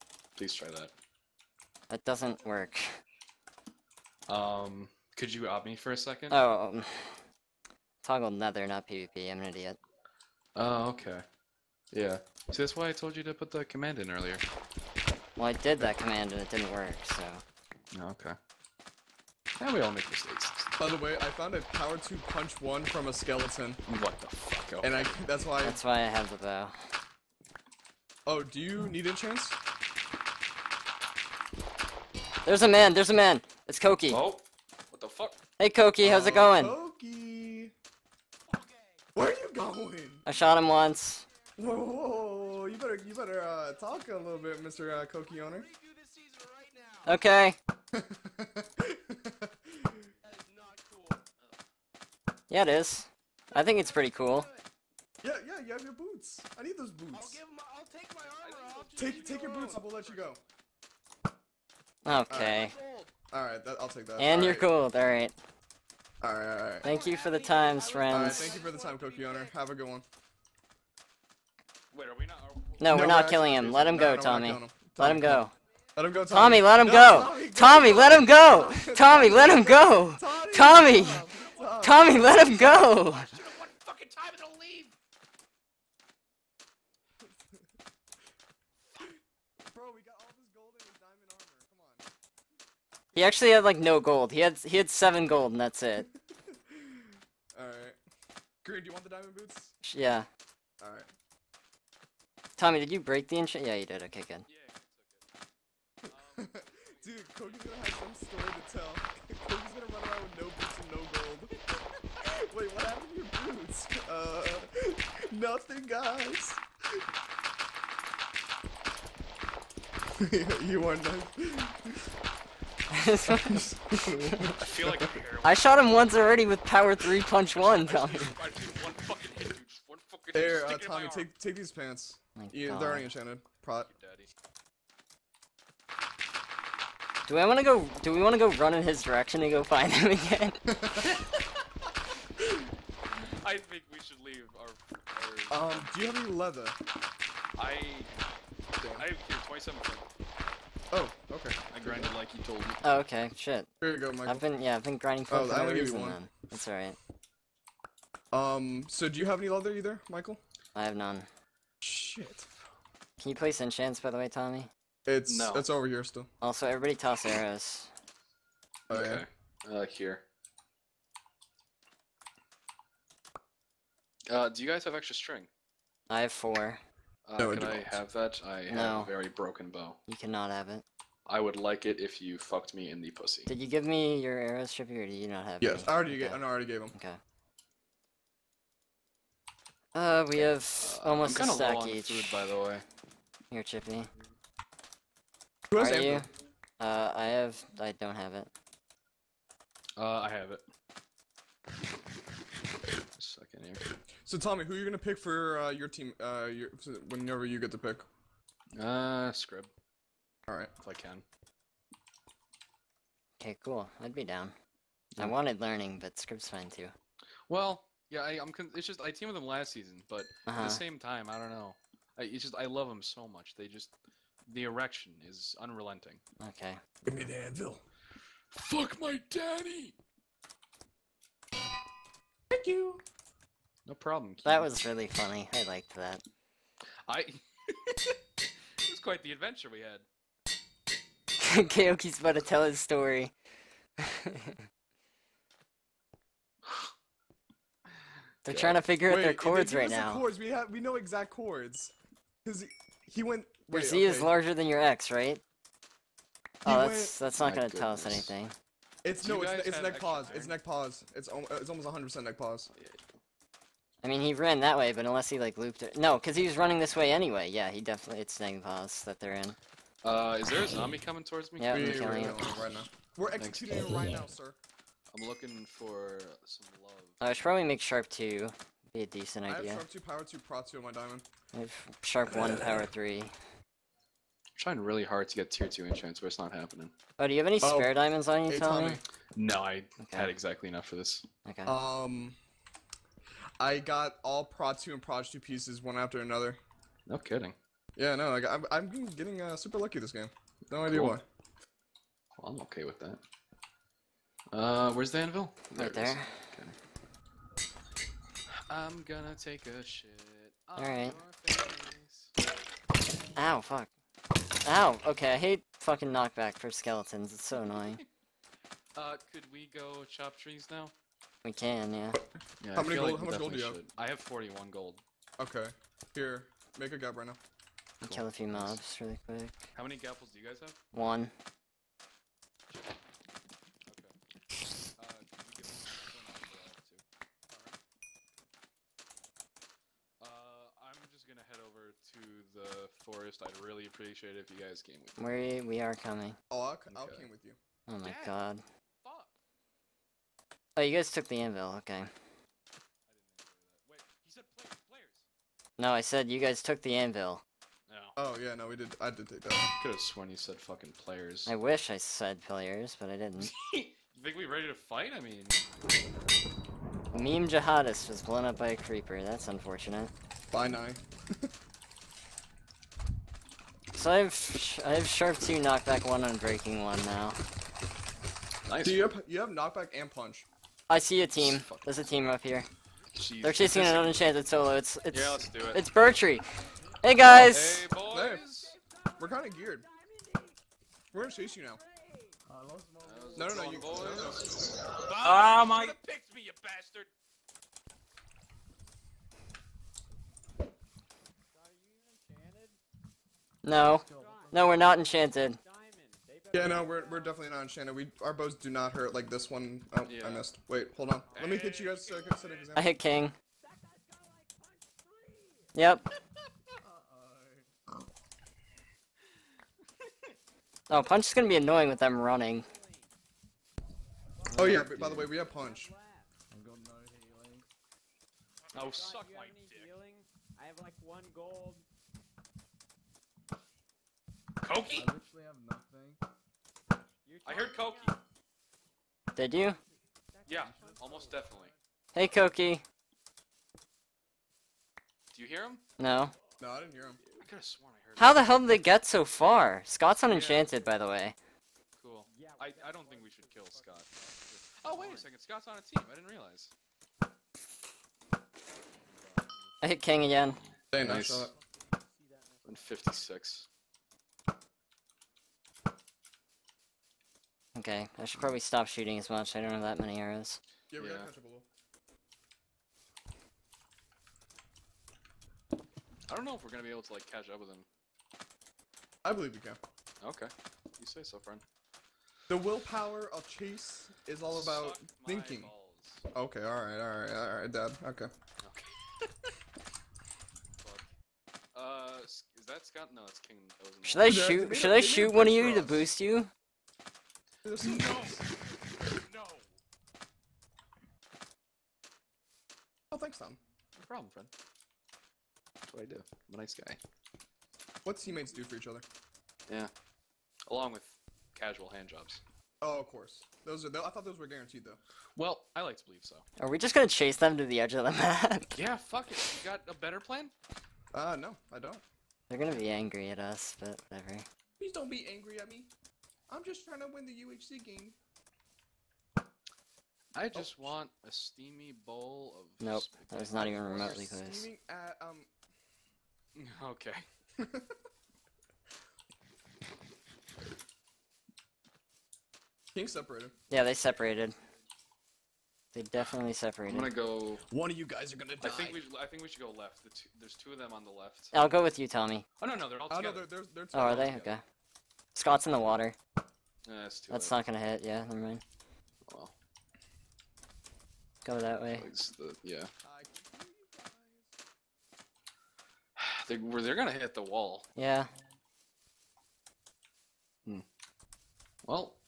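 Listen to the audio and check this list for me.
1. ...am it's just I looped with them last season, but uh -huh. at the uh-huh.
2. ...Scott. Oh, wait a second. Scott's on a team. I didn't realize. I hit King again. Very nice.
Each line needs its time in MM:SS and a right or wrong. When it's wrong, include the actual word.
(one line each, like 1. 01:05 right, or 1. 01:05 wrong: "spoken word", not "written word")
1. 03:38 wrong: "teamed", not "looped"
2. 07:33 right.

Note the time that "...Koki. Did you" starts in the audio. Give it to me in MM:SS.
07:17.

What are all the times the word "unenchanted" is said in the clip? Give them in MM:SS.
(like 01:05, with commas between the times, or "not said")
06:23, 07:30.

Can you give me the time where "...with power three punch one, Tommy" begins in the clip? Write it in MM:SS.
02:06.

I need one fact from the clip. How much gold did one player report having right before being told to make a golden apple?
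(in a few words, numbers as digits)
41.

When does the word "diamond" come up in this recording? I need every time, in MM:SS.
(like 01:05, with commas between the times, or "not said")
01:39, 04:40, 04:47.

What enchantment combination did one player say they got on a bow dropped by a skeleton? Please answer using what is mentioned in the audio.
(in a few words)
Power 2 Punch 1.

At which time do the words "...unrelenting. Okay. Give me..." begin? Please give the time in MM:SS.
03:45.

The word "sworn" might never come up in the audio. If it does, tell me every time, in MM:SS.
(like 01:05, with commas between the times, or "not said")
05:59, 07:27.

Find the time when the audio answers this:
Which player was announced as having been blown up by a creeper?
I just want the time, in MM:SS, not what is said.
06:07.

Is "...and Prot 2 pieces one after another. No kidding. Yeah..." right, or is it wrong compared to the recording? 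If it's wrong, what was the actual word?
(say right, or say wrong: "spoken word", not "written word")
right.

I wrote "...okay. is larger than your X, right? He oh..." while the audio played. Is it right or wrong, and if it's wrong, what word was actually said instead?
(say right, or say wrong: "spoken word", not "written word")
right.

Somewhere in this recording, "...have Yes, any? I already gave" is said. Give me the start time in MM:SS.
03:05.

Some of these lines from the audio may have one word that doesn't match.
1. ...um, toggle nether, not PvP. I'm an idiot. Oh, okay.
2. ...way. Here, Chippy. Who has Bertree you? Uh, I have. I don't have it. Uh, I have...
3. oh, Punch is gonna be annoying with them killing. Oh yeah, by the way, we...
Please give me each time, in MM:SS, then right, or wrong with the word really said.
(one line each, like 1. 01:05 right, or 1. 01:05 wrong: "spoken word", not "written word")
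1. 00:06 right
2. 03:12 wrong: "Are", not "Bertree"
3. 07:00 wrong: "running", not "killing".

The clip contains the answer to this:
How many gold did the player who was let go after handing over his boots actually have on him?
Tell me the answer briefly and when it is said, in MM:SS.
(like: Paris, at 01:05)
7, at 01:34.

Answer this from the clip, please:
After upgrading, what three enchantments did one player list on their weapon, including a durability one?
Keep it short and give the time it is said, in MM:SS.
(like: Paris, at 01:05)
Sharp 2, Knockback 1, Breaking 1, at 06:15.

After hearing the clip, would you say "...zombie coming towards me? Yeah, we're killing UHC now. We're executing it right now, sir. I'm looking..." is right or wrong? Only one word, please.
wrong.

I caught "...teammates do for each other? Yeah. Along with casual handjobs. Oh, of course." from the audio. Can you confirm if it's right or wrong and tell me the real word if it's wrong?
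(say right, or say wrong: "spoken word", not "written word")
right.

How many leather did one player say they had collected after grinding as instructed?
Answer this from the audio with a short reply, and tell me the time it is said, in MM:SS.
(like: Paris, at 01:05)
27, at 02:29.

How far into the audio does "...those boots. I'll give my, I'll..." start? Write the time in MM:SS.
00:56.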